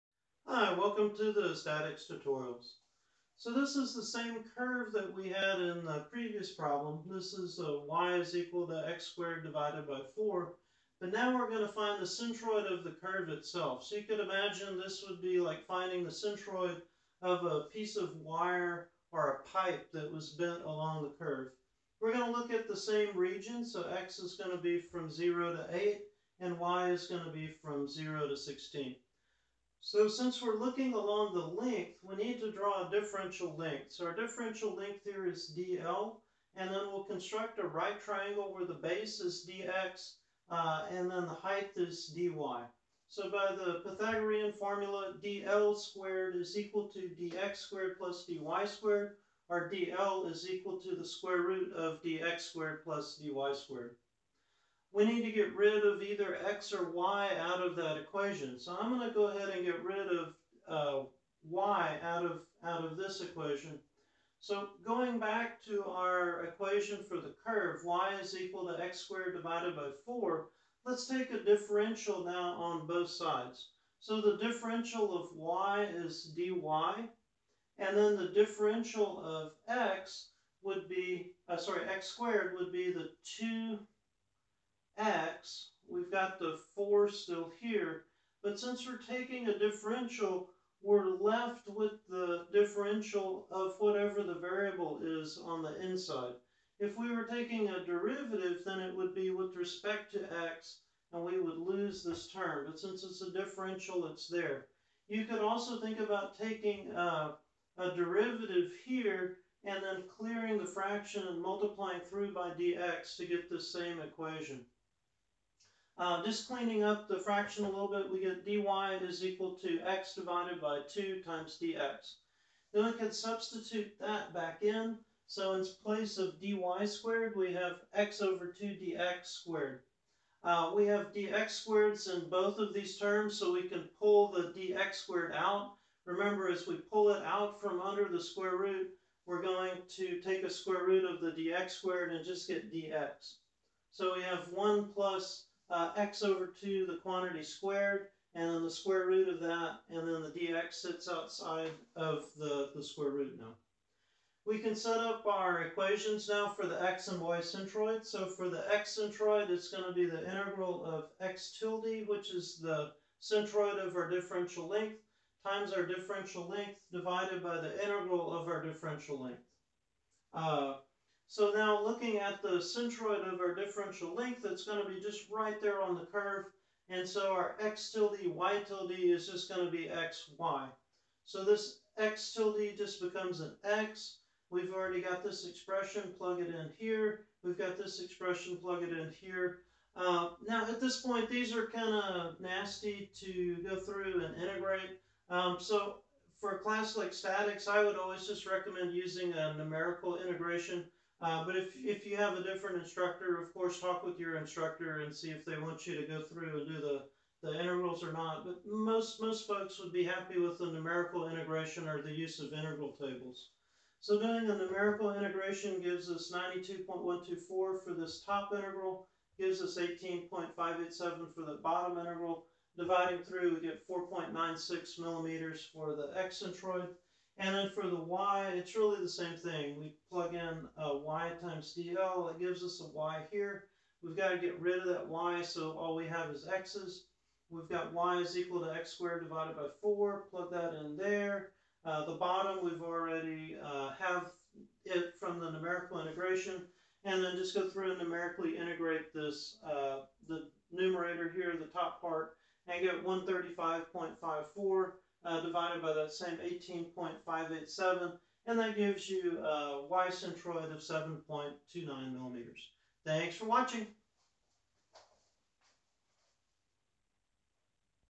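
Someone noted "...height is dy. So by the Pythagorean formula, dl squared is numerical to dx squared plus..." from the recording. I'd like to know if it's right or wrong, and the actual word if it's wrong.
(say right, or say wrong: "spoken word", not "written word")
wrong: "equal", not "numerical".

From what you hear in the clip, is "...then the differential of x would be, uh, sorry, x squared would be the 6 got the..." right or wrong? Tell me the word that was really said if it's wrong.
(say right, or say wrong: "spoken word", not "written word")
wrong: "2", not "6".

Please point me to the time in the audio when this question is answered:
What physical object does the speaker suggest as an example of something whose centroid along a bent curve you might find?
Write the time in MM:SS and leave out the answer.
00:17.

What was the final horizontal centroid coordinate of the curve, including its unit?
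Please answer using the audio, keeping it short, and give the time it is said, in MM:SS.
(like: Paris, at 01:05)
4.96 millimeters, at 03:43.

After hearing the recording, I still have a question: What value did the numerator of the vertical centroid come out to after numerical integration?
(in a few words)
135.54.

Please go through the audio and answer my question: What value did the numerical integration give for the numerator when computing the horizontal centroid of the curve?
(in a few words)
92.124.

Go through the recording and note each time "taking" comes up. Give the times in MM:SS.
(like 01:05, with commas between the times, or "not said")
01:29, 01:37, 01:46.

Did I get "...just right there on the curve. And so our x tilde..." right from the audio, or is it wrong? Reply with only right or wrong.
right.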